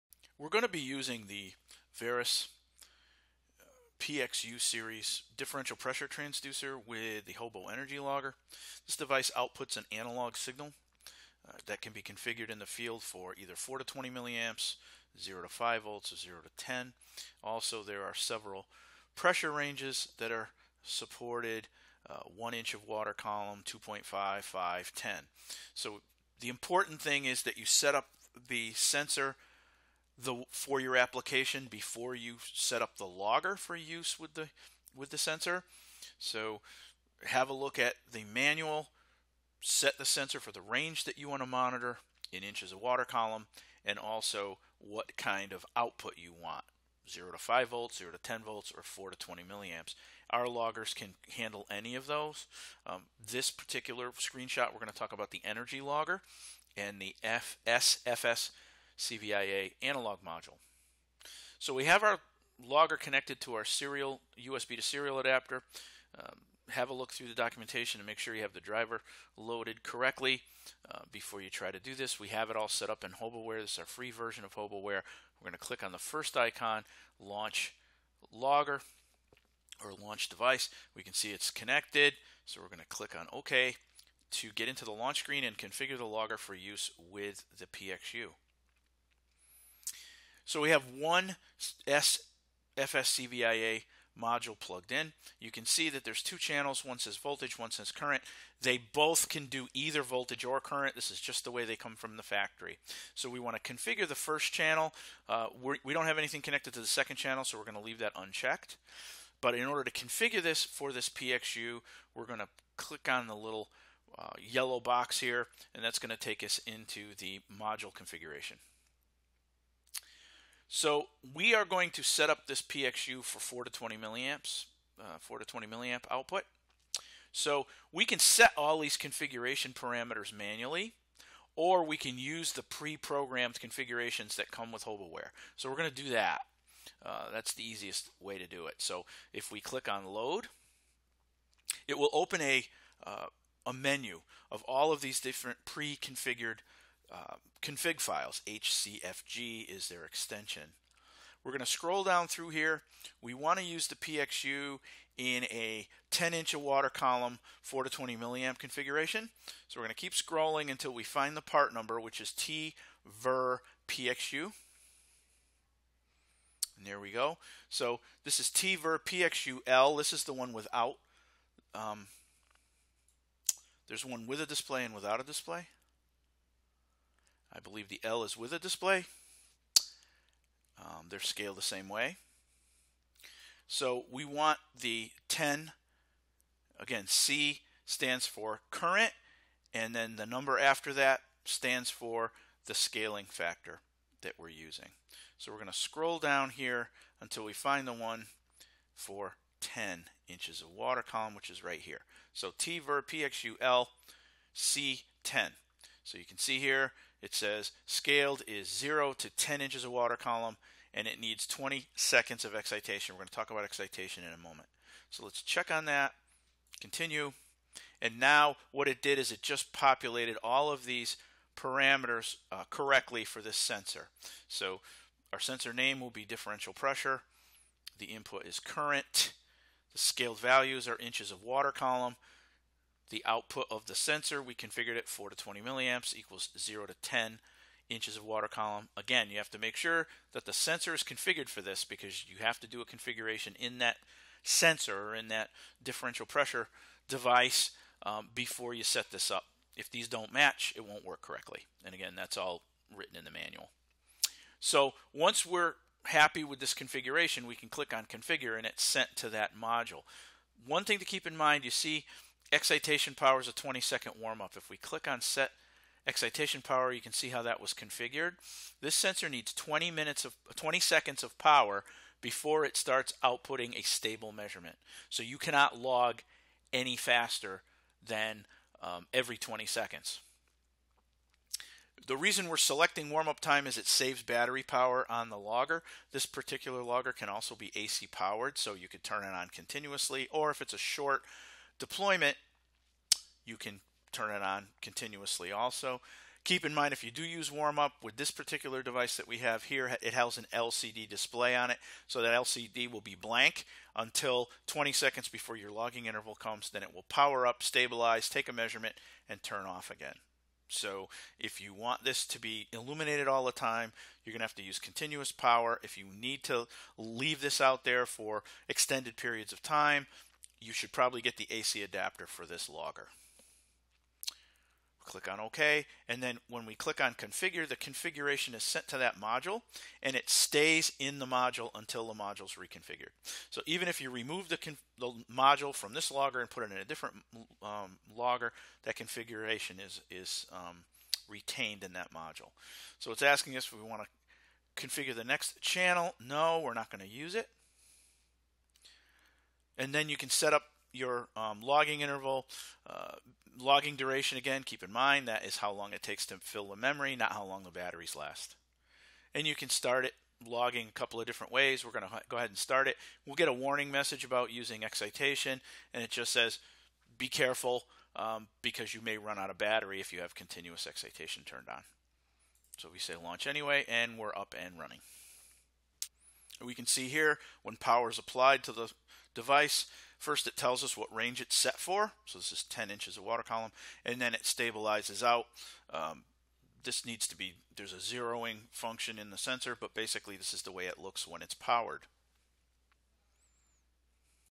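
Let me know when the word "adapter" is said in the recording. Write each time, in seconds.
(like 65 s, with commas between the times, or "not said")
65 s, 321 s.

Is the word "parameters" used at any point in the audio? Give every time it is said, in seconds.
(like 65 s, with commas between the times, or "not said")
129 s, 221 s.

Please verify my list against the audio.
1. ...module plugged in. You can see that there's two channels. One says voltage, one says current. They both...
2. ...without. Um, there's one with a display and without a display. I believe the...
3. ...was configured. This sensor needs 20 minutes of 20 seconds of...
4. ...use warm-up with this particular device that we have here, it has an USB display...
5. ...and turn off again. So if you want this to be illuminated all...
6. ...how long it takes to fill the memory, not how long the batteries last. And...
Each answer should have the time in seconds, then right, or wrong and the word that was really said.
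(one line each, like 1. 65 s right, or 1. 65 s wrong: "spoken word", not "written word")
1. 94 s right
2. 170 s right
3. 267 s right
4. 297 s wrong: "LCD", not "USB"
5. 309 s right
6. 355 s right.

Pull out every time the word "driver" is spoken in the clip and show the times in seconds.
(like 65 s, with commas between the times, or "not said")
68 s.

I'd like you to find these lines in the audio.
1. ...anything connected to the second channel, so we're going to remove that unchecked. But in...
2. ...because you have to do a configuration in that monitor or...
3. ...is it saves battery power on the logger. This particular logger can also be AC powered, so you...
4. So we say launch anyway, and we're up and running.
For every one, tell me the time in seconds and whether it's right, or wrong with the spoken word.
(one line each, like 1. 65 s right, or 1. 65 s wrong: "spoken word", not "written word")
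1. 106 s wrong: "leave", not "remove"
2. 241 s wrong: "sensor", not "monitor"
3. 283 s right
4. 372 s right.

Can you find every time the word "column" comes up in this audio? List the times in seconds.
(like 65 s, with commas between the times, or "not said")
23 s, 43 s, 156 s, 201 s, 210 s, 231 s, 238 s, 383 s.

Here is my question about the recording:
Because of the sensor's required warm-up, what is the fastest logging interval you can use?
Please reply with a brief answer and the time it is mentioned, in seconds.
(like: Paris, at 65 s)
every 20 seconds, at 279 s.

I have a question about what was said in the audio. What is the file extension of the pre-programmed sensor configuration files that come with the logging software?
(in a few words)
HCFG.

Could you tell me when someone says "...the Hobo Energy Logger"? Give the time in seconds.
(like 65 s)
7 s.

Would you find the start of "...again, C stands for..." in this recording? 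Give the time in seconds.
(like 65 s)
186 s.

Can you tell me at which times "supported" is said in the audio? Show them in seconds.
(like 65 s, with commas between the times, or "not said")
20 s.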